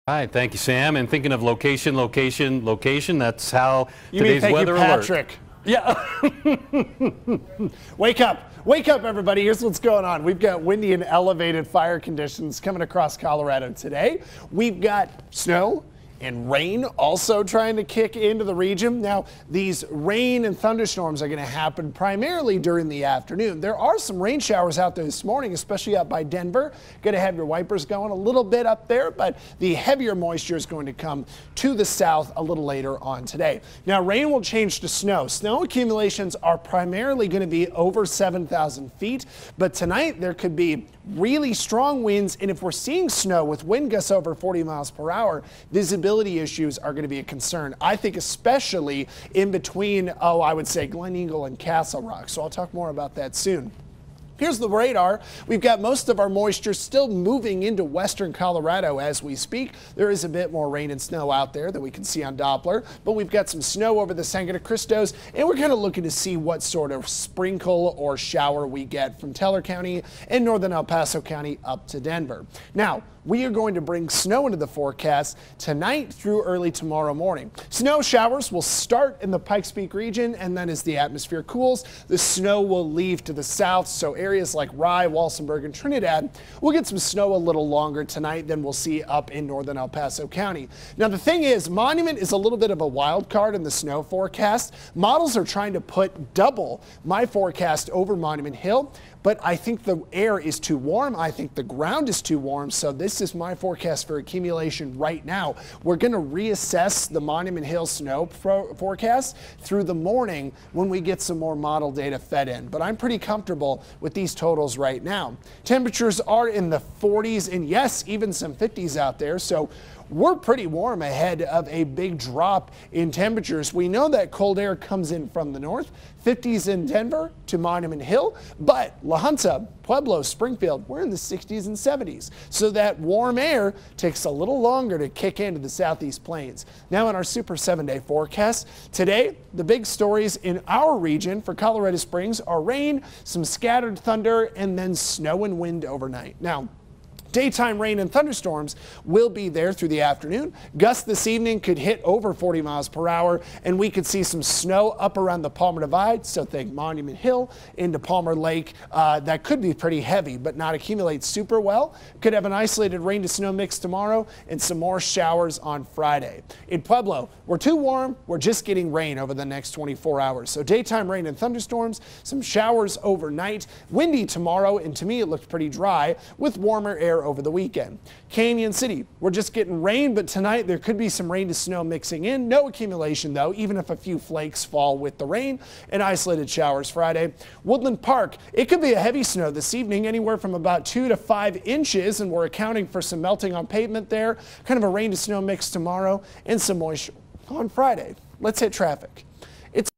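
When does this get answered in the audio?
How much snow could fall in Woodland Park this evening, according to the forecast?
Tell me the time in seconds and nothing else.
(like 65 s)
190 s.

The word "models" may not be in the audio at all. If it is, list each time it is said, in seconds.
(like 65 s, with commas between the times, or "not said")
94 s, 111 s.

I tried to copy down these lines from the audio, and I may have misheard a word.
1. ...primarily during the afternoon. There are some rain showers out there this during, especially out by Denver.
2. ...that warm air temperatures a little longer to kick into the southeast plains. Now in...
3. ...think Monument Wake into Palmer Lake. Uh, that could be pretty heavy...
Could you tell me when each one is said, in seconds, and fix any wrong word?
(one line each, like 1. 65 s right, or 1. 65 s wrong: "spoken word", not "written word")
1. 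21 s wrong: "morning", not "during"
2. 132 s wrong: "takes", not "temperatures"
3. 156 s wrong: "Hill", not "Wake".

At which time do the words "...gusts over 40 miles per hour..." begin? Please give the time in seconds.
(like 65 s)
43 s.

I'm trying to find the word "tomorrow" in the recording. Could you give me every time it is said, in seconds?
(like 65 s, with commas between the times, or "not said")
76 s, 163 s, 174 s, 195 s.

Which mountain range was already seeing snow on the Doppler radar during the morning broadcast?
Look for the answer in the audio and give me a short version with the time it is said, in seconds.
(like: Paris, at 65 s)
Sangre de Cristos, at 64 s.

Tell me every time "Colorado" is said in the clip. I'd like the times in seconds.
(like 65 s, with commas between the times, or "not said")
13 s, 58 s, 141 s.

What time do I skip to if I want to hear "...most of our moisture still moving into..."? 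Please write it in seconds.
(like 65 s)
55 s.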